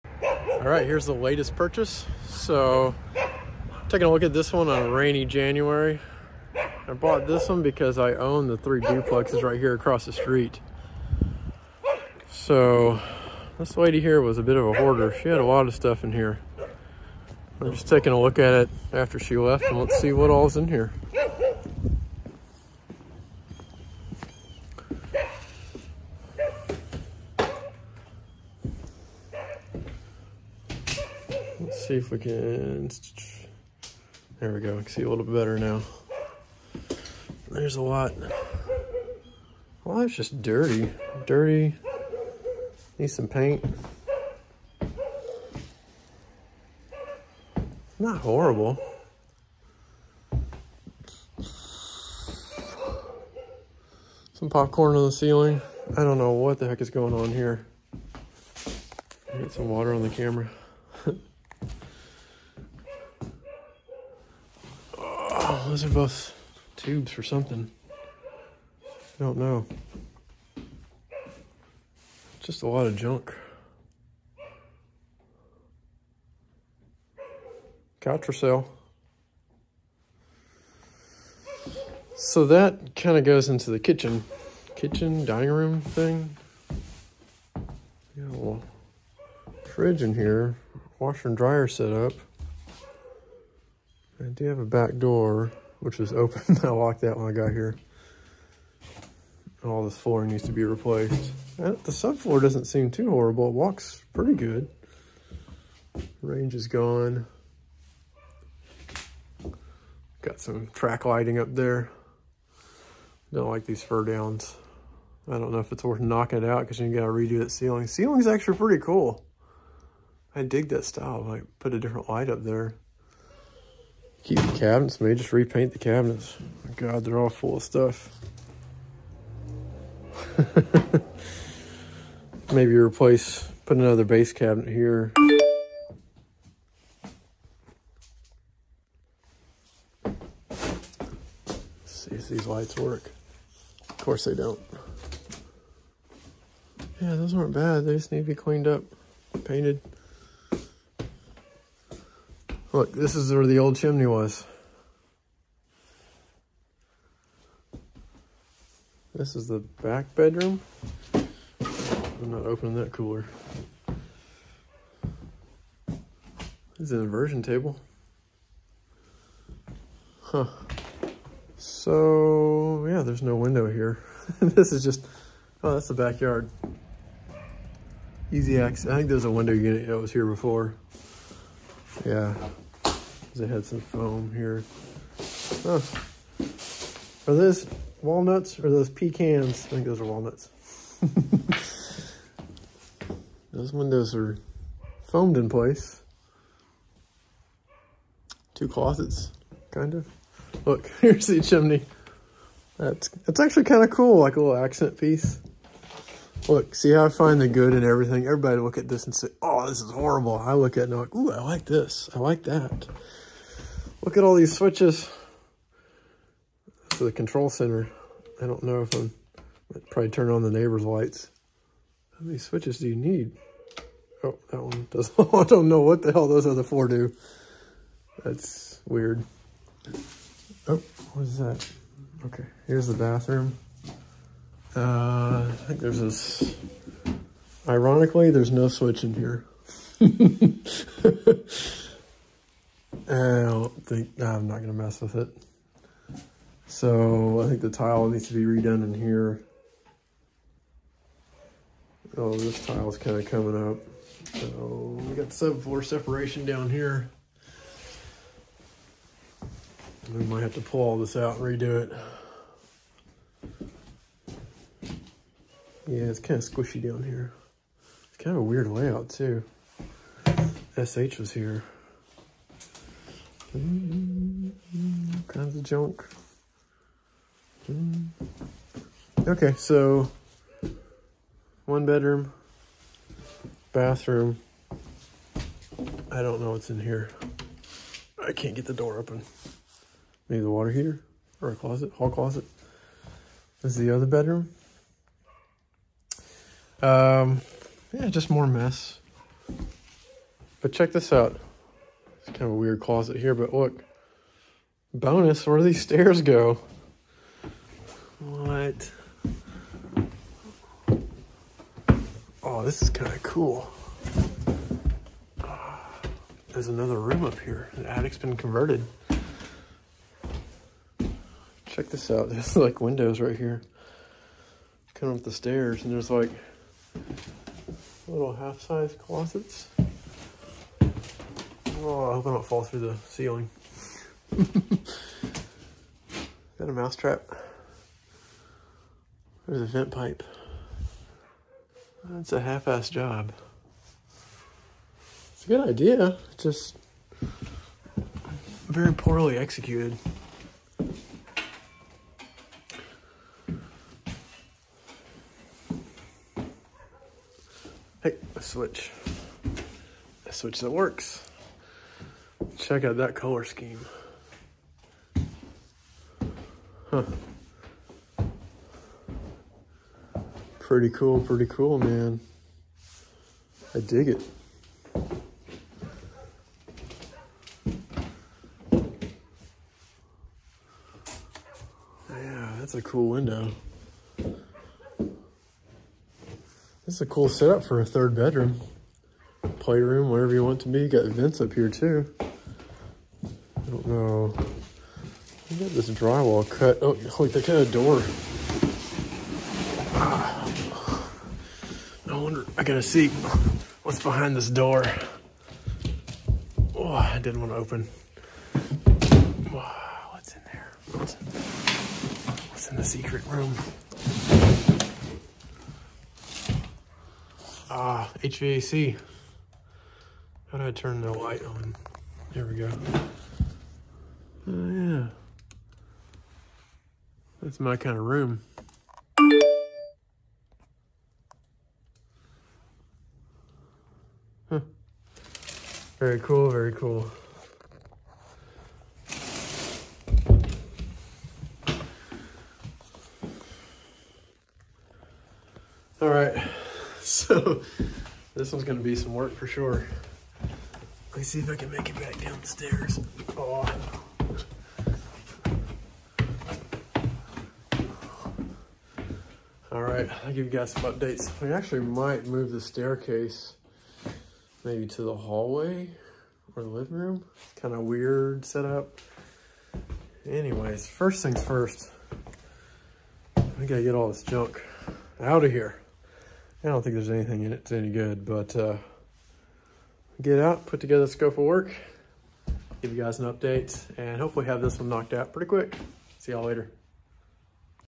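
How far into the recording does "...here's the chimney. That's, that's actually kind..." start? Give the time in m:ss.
3:21.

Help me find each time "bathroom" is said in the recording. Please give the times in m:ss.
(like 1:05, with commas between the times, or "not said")
3:52, 4:43.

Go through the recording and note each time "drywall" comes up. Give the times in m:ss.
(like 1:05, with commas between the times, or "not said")
6:35.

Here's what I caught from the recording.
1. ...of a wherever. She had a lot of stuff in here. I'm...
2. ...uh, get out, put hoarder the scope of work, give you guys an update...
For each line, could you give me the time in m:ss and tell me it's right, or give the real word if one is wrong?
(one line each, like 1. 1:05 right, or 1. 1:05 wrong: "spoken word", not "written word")
1. 0:14 wrong: "hoarder", not "wherever"
2. 7:58 wrong: "together", not "hoarder".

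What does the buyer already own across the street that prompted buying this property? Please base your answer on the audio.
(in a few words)
3 duplexes.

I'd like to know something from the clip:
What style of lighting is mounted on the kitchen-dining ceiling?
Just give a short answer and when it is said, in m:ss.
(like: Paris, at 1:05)
Track lighting, at 1:50.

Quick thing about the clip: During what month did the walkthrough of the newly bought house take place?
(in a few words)
January.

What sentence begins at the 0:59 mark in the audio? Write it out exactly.
Get some water on the camera.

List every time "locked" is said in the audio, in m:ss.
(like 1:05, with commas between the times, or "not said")
1:36.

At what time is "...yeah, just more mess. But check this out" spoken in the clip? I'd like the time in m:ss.
4:57.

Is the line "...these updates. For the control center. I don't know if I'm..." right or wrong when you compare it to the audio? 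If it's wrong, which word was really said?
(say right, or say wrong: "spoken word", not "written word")
wrong: "switches", not "updates".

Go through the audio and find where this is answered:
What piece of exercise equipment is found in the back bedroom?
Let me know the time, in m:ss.
2:47.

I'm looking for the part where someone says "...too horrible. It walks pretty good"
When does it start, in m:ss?
1:42.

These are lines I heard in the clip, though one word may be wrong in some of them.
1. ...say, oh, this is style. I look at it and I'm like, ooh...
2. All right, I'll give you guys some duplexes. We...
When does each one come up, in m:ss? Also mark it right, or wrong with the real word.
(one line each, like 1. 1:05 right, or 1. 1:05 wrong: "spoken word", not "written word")
1. 3:29 wrong: "horrible", not "style"
2. 7:39 wrong: "updates", not "duplexes".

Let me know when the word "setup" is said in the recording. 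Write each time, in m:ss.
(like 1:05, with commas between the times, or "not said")
6:27, 7:48.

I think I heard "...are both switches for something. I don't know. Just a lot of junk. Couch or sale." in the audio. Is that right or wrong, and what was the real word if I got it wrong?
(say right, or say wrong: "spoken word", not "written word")
wrong: "tubes", not "switches".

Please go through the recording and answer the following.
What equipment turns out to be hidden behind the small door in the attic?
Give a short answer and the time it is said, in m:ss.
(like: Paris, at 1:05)
HVAC, at 6:58.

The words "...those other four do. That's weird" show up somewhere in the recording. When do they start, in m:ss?
3:46.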